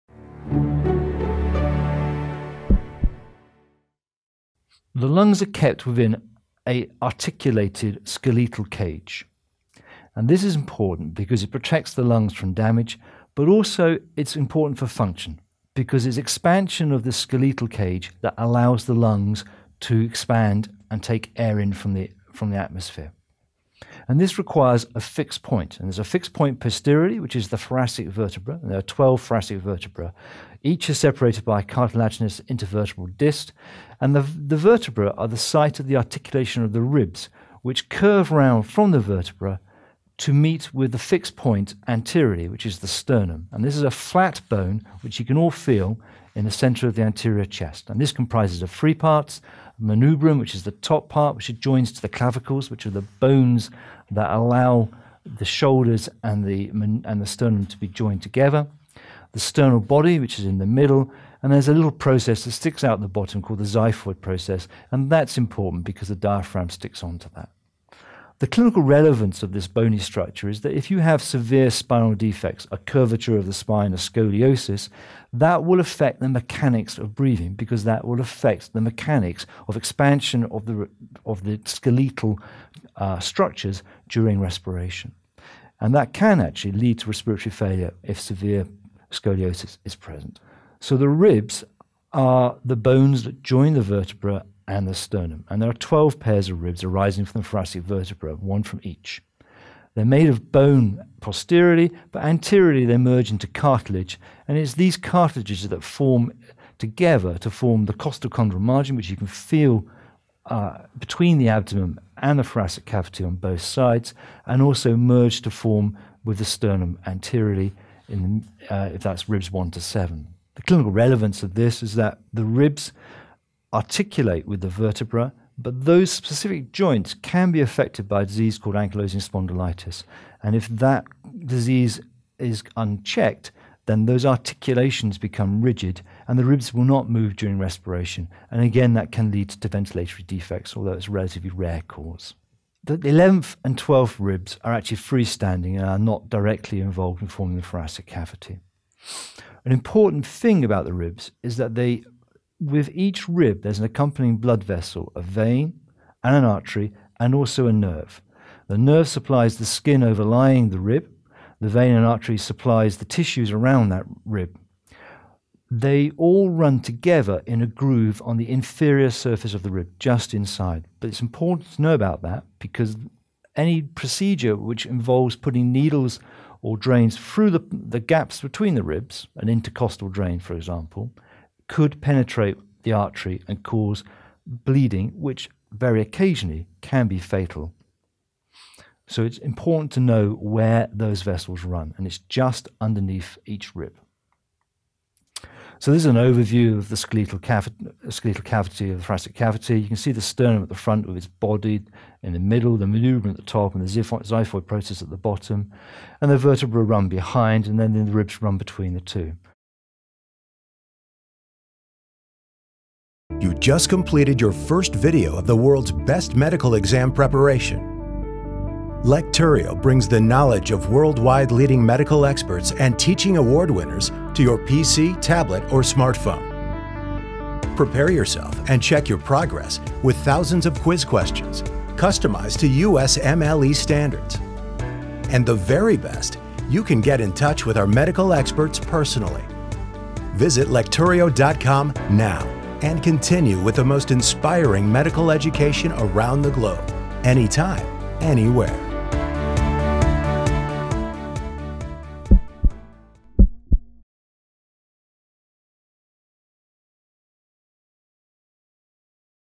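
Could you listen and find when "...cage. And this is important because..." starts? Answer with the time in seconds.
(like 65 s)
8 s.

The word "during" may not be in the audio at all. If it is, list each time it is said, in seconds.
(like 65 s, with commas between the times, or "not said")
84 s, 137 s.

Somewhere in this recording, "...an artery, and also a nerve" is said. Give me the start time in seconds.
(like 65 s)
156 s.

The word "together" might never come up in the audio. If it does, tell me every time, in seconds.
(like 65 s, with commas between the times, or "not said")
58 s, 106 s, 166 s.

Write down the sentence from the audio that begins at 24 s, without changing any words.
And this requires a fixed point.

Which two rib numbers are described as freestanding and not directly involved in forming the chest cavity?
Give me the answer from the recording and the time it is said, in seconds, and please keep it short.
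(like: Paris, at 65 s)
11th and 12th, at 142 s.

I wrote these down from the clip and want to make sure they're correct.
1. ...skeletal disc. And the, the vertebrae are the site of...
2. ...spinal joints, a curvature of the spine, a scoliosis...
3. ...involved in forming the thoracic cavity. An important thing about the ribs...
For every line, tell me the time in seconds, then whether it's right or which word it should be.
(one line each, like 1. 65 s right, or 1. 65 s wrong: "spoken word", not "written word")
1. 32 s wrong: "intervertebral", not "skeletal"
2. 71 s wrong: "defects", not "joints"
3. 146 s right.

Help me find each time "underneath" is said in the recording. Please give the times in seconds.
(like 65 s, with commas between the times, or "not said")
192 s.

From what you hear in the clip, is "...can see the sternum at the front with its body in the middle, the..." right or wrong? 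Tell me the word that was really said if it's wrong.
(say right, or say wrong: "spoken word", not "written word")
right.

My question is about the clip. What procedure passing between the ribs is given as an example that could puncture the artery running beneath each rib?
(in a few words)
intercostal drain.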